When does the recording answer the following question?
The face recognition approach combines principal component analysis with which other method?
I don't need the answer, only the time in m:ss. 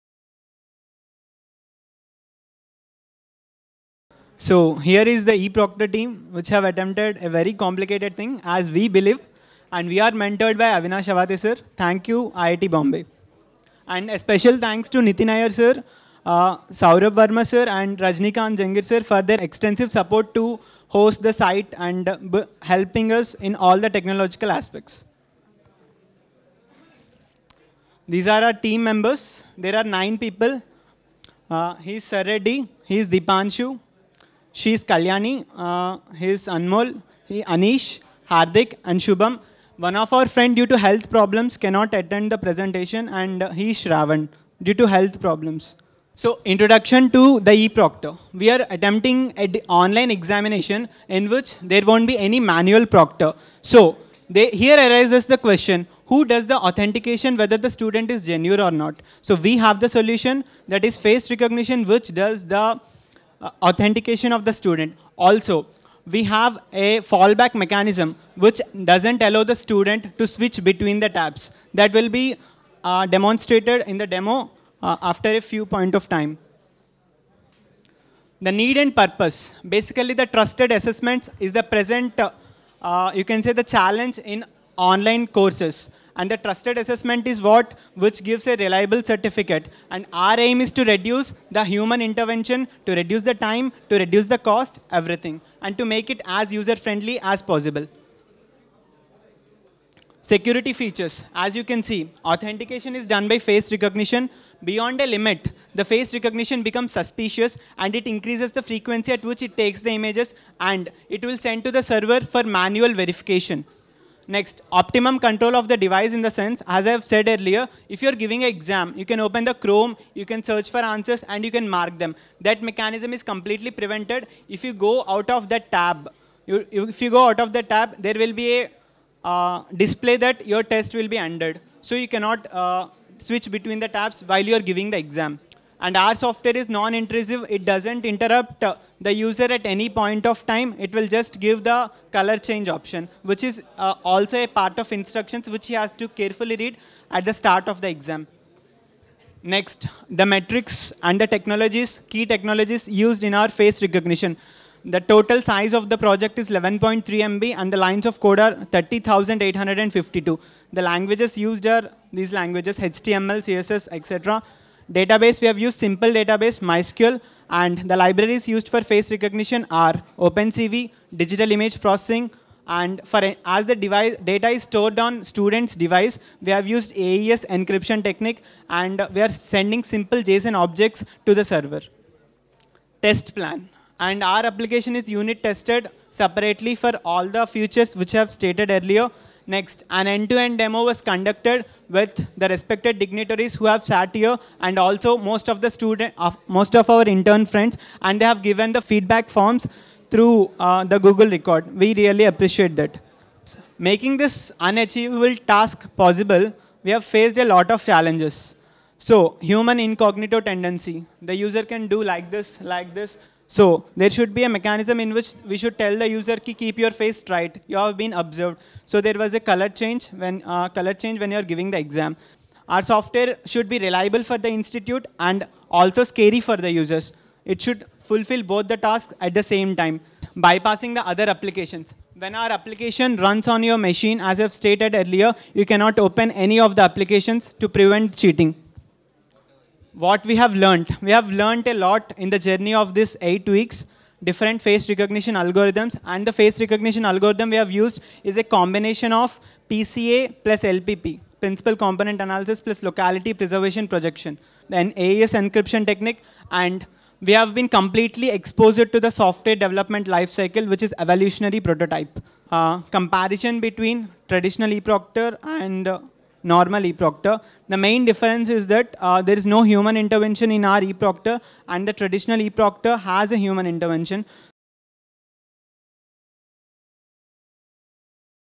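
4:12.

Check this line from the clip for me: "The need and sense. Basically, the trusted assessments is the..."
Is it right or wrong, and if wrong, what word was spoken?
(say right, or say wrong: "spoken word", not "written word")
wrong: "purpose", not "sense".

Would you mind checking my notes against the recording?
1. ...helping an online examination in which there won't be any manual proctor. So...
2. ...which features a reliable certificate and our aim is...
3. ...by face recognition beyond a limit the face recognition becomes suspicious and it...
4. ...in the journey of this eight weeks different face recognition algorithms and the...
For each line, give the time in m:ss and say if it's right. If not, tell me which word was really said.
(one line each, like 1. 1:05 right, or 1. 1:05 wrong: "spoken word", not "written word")
1. 0:48 wrong: "attempting", not "helping"
2. 1:27 wrong: "gives", not "features"
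3. 1:43 right
4. 4:02 right.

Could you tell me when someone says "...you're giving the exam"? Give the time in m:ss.
2:14.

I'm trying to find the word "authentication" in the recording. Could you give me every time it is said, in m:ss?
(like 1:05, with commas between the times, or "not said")
0:56, 1:03, 1:42.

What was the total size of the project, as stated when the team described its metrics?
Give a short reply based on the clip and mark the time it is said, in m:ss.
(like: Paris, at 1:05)
11.3 MB, at 2:36.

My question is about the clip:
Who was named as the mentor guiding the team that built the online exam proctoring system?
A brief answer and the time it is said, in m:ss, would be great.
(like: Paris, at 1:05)
Avinash Awate, at 0:10.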